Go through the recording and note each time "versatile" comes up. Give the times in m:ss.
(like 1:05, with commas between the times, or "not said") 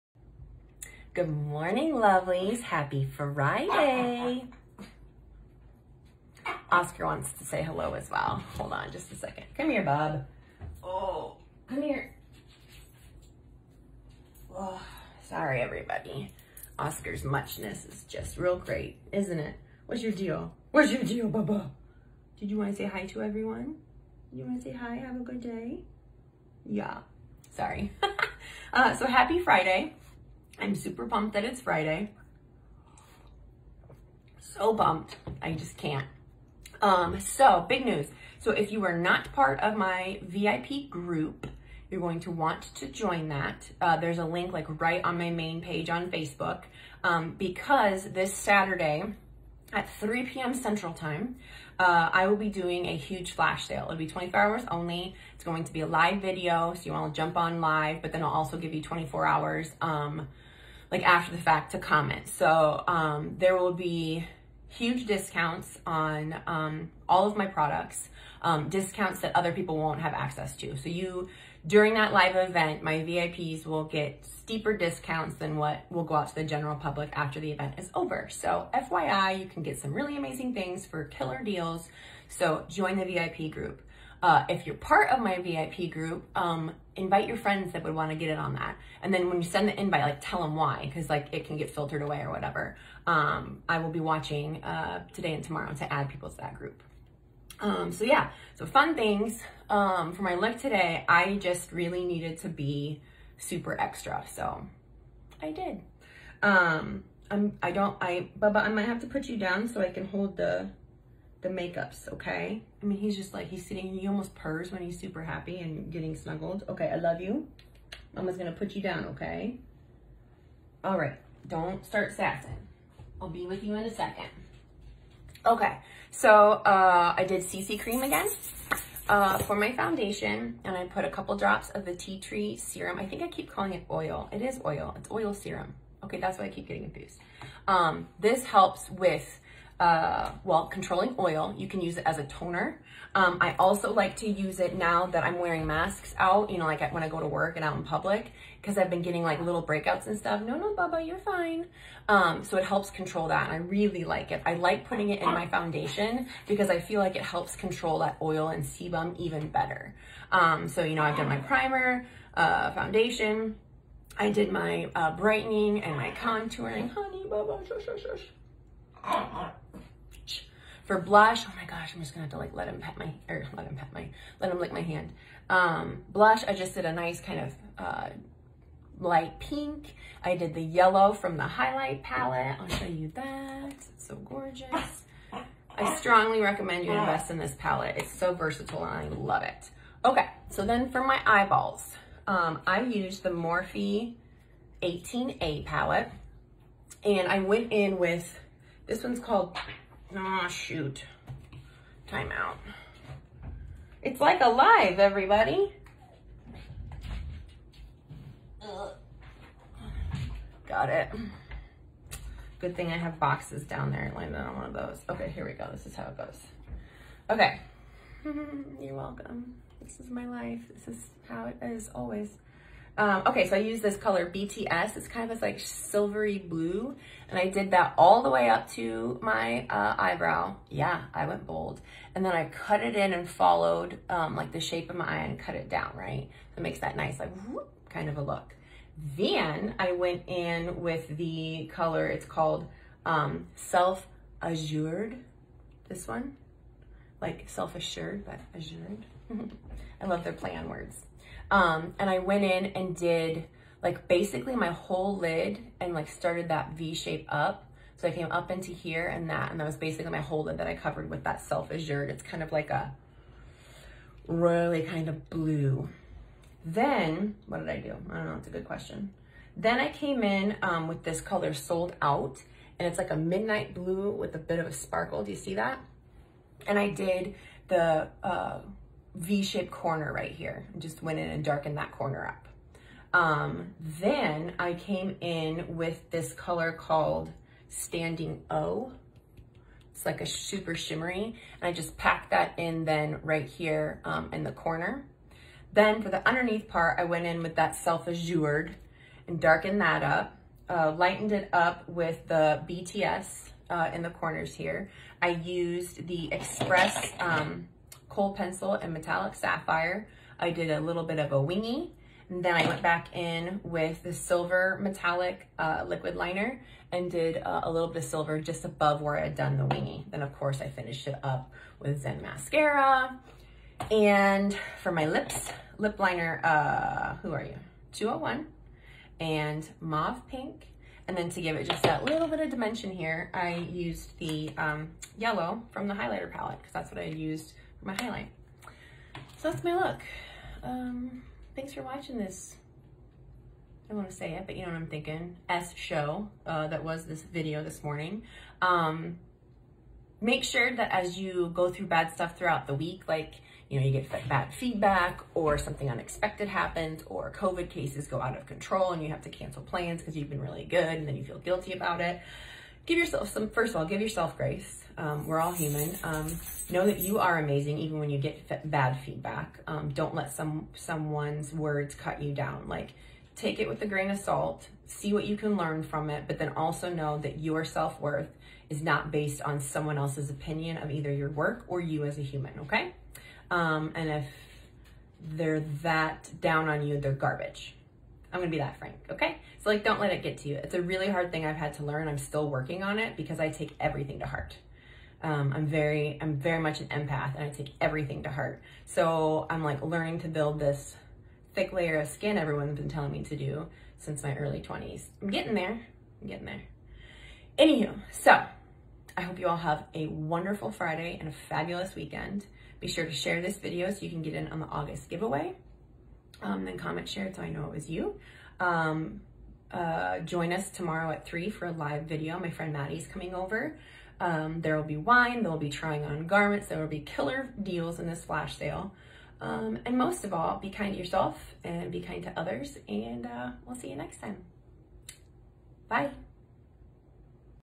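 3:08.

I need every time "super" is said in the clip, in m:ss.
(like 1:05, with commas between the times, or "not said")
0:30, 1:43, 1:54, 4:50.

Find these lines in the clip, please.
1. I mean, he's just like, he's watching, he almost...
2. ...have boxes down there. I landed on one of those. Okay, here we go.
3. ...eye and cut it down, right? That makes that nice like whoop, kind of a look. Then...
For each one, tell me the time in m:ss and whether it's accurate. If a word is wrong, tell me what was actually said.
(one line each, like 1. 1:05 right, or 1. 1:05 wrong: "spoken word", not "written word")
1. 1:52 wrong: "sitting", not "watching"
2. 3:32 right
3. 3:55 right.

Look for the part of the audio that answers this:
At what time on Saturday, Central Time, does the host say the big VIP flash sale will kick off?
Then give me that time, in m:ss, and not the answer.
0:49.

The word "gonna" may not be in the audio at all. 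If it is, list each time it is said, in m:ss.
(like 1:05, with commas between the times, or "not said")
1:58, 2:52, 6:28.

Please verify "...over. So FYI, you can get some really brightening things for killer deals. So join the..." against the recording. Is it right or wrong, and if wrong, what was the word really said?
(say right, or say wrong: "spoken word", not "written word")
wrong: "amazing", not "brightening".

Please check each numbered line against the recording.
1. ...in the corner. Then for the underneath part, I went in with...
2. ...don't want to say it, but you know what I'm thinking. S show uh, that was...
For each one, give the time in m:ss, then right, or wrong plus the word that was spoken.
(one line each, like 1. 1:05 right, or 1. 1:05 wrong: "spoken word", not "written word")
1. 4:54 right
2. 5:43 right.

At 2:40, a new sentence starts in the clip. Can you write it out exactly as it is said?
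Um, so, you know, I've done my primer, uh, foundation.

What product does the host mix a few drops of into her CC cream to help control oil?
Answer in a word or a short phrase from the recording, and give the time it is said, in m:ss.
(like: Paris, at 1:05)
tea tree serum, at 2:11.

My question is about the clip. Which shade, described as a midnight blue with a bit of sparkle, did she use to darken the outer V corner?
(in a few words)
Sold Out.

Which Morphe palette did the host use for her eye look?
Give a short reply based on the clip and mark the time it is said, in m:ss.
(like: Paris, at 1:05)
18A, at 3:14.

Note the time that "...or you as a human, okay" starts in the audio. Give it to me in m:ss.
6:21.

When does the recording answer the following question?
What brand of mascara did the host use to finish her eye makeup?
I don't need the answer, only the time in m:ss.
5:22.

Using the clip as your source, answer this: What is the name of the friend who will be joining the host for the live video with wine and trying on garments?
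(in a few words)
Maddie.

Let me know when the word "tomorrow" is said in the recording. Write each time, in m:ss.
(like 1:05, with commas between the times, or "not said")
1:35, 7:00.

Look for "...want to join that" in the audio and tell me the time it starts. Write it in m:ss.
0:42.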